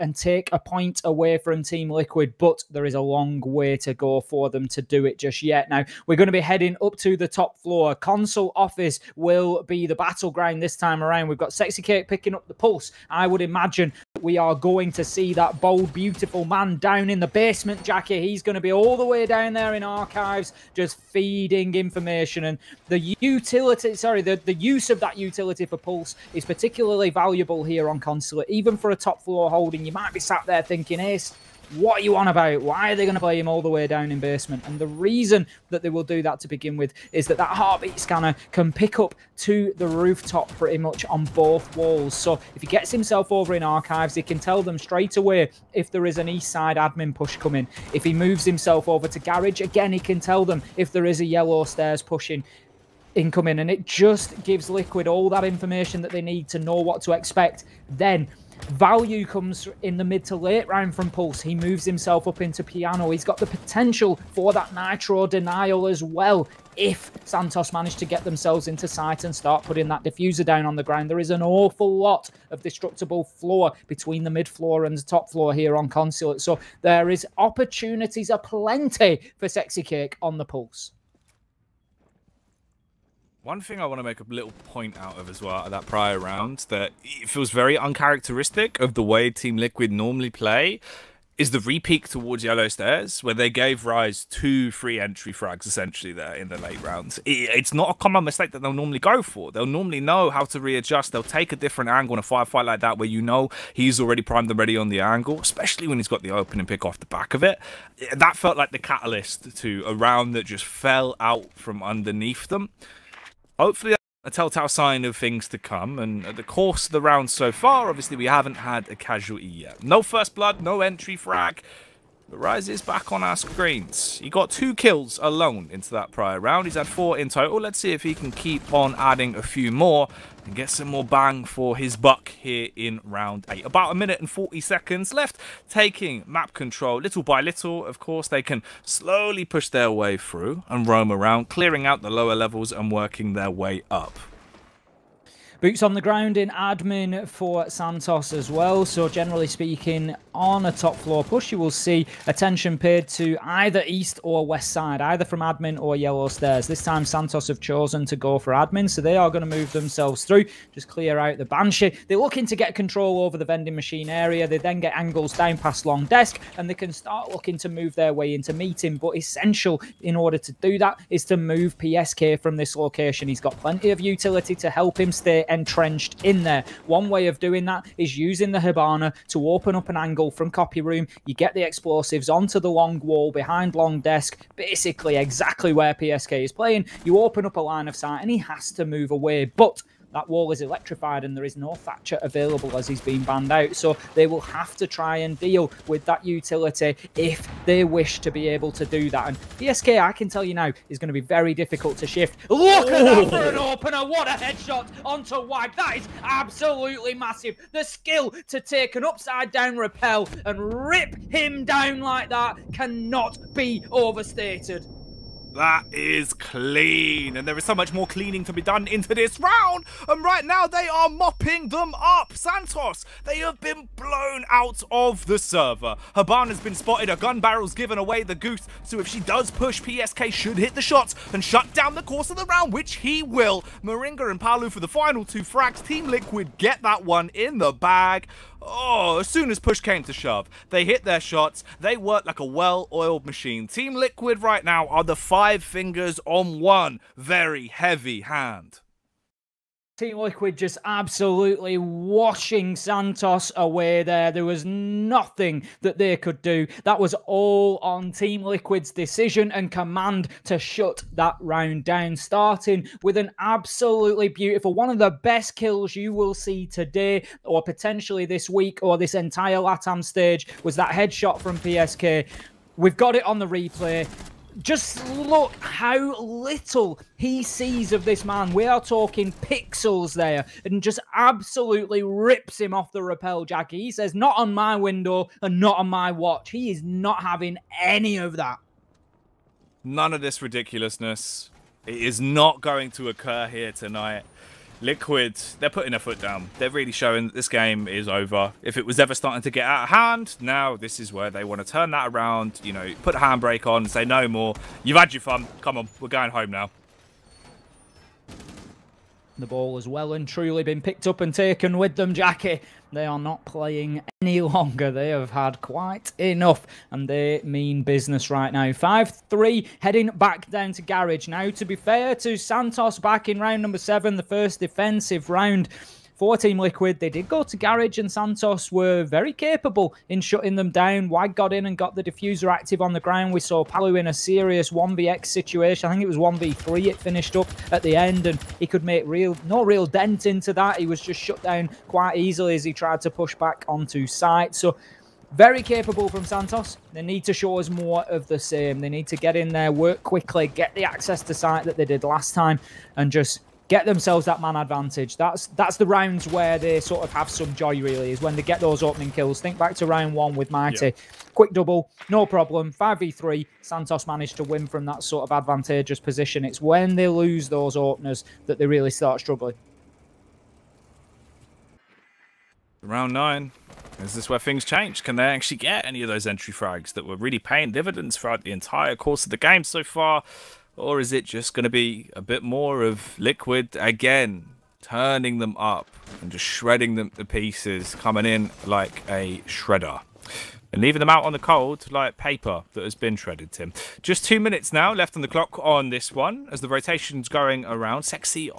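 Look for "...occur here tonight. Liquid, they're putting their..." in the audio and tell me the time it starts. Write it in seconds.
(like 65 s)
293 s.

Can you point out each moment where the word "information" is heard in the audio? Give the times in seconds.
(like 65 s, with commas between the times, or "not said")
21 s, 55 s.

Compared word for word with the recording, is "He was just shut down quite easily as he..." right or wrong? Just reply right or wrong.
right.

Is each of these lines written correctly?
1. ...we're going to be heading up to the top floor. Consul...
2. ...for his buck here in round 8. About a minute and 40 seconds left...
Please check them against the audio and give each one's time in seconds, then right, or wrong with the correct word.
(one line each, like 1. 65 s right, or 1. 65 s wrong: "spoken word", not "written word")
1. 6 s right
2. 131 s right.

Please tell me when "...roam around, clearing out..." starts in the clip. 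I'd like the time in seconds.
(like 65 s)
140 s.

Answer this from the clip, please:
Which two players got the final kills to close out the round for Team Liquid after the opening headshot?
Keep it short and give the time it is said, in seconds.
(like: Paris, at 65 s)
Moringa and Paluh, at 233 s.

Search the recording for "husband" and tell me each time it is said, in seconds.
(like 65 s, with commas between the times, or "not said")
not said.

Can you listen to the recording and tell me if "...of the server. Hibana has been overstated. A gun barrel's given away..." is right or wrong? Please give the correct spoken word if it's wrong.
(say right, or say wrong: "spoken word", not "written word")
wrong: "spotted", not "overstated".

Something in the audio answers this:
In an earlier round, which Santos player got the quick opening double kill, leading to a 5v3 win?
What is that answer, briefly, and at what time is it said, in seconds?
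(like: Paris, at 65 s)
Mighty, at 360 s.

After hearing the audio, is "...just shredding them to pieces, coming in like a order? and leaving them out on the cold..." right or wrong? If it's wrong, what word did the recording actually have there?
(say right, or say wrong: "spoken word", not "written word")
wrong: "shredder", not "order".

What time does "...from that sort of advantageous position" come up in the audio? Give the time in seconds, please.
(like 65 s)
364 s.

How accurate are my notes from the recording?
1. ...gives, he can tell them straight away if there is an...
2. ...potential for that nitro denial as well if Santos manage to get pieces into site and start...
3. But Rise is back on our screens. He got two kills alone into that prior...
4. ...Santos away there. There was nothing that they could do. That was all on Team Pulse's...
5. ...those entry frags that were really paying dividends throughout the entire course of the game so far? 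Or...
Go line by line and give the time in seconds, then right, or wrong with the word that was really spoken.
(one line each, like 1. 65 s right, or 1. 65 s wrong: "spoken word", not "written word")
1. 43 s wrong: "archives", not "gives"
2. 63 s wrong: "themselves", not "pieces"
3. 122 s right
4. 252 s wrong: "Liquid", not "Pulse"
5. 376 s right.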